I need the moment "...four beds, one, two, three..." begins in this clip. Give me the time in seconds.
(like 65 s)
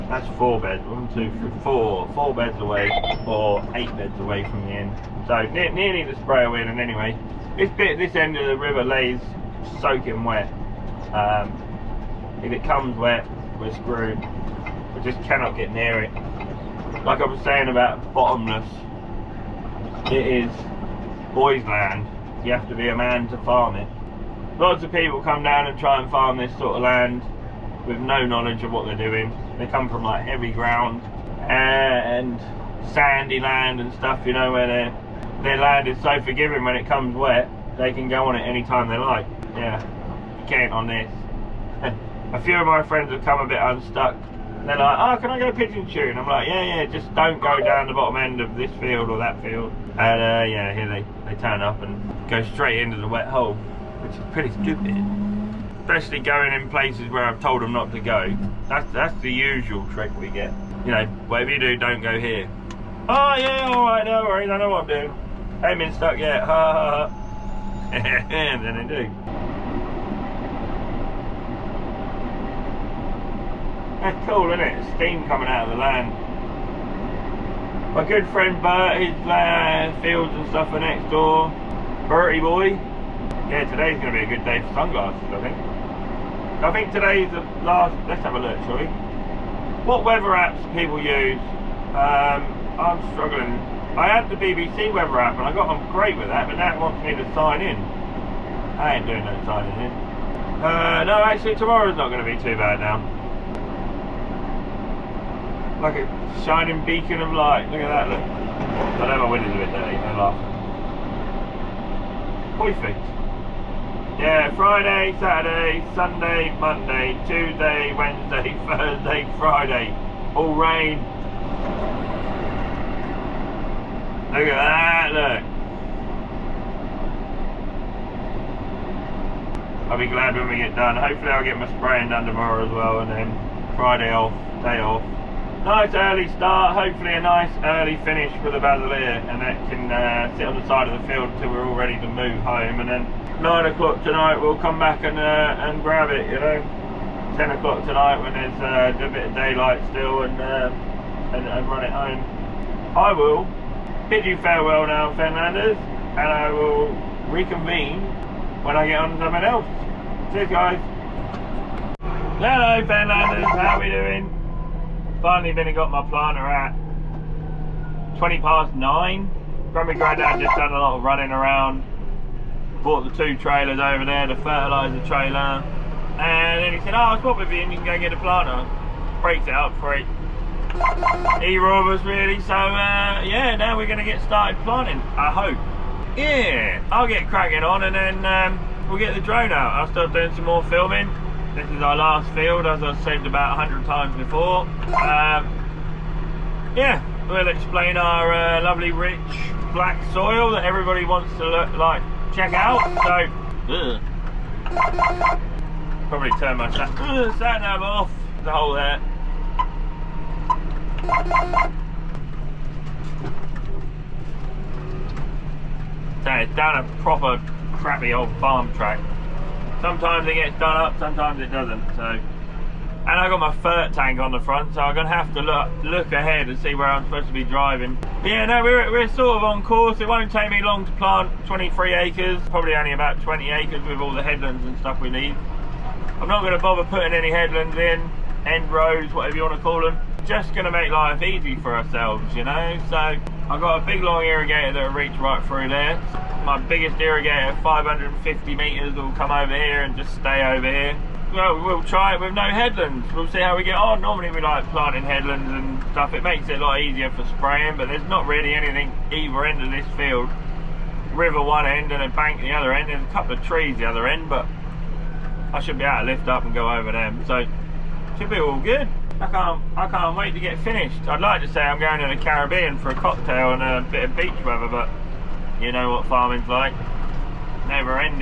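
0 s.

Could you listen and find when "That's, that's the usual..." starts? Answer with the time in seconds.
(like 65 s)
58 s.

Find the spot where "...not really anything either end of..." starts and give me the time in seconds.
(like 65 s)
258 s.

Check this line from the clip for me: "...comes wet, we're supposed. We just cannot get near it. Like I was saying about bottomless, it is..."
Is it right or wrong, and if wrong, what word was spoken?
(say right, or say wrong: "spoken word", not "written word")
wrong: "screwed", not "supposed".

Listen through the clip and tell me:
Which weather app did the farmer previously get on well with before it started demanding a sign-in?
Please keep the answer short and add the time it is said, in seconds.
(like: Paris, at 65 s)
BBC weather app, at 94 s.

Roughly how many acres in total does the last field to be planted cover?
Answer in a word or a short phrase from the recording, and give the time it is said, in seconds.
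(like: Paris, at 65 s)
23 acres, at 231 s.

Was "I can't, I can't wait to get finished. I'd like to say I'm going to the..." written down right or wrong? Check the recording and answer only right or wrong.
right.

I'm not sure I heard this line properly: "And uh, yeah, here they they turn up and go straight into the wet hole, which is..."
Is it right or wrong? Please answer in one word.
right.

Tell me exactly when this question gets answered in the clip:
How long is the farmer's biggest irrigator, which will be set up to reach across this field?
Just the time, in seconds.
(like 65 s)
247 s.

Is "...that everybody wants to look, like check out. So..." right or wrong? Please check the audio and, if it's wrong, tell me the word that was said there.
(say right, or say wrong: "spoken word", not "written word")
right.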